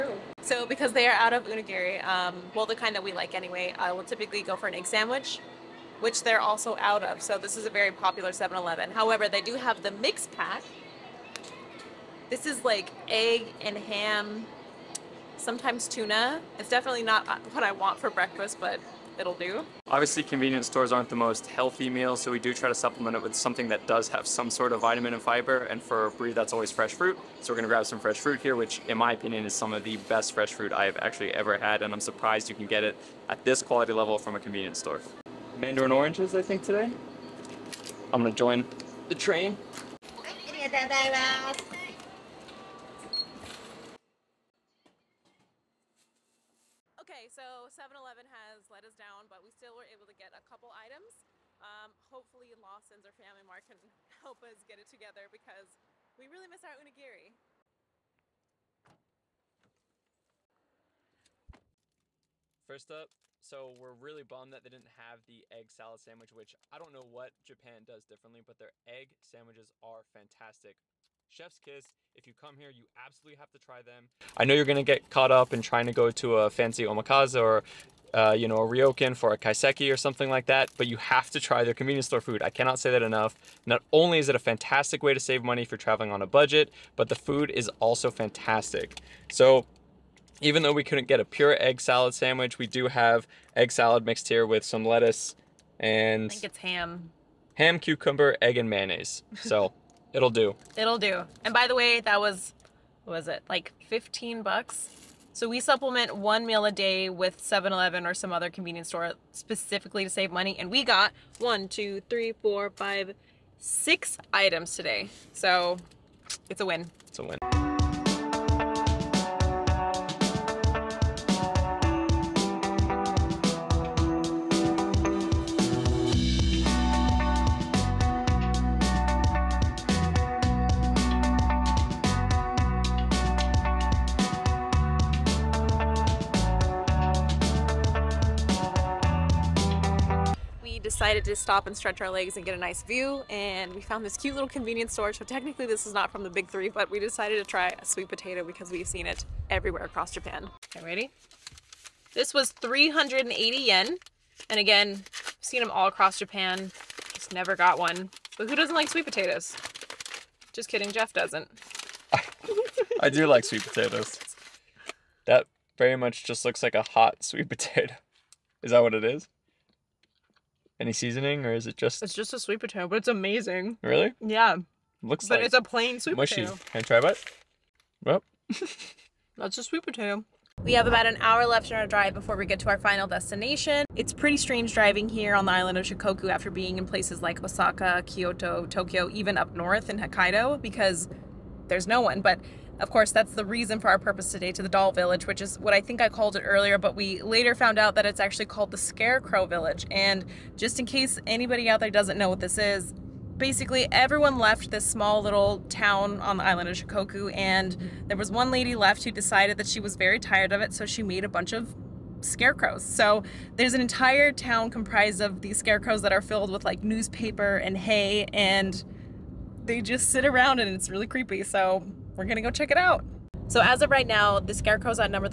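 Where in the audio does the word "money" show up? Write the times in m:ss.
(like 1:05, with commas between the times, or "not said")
1:25, 1:50.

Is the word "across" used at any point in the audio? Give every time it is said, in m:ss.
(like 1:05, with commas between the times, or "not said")
2:29, 2:35.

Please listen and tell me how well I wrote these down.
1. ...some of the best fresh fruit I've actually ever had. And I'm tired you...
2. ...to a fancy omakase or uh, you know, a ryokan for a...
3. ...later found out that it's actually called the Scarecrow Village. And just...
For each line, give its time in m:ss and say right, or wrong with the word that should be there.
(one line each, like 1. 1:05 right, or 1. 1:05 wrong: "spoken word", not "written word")
1. 0:29 wrong: "surprised", not "tired"
2. 1:16 right
3. 3:17 right.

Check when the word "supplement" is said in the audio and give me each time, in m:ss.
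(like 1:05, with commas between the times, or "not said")
0:22, 1:45.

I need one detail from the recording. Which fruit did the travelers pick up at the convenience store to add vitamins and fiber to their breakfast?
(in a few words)
Mandarin oranges.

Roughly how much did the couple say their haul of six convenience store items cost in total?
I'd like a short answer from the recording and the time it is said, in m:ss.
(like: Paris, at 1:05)
15 bucks, at 1:43.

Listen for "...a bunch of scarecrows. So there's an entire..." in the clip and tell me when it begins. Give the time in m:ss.
3:31.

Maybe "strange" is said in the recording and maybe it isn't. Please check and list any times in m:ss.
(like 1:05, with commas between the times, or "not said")
3:04.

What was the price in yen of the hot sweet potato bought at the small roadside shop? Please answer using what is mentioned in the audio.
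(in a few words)
380 yen.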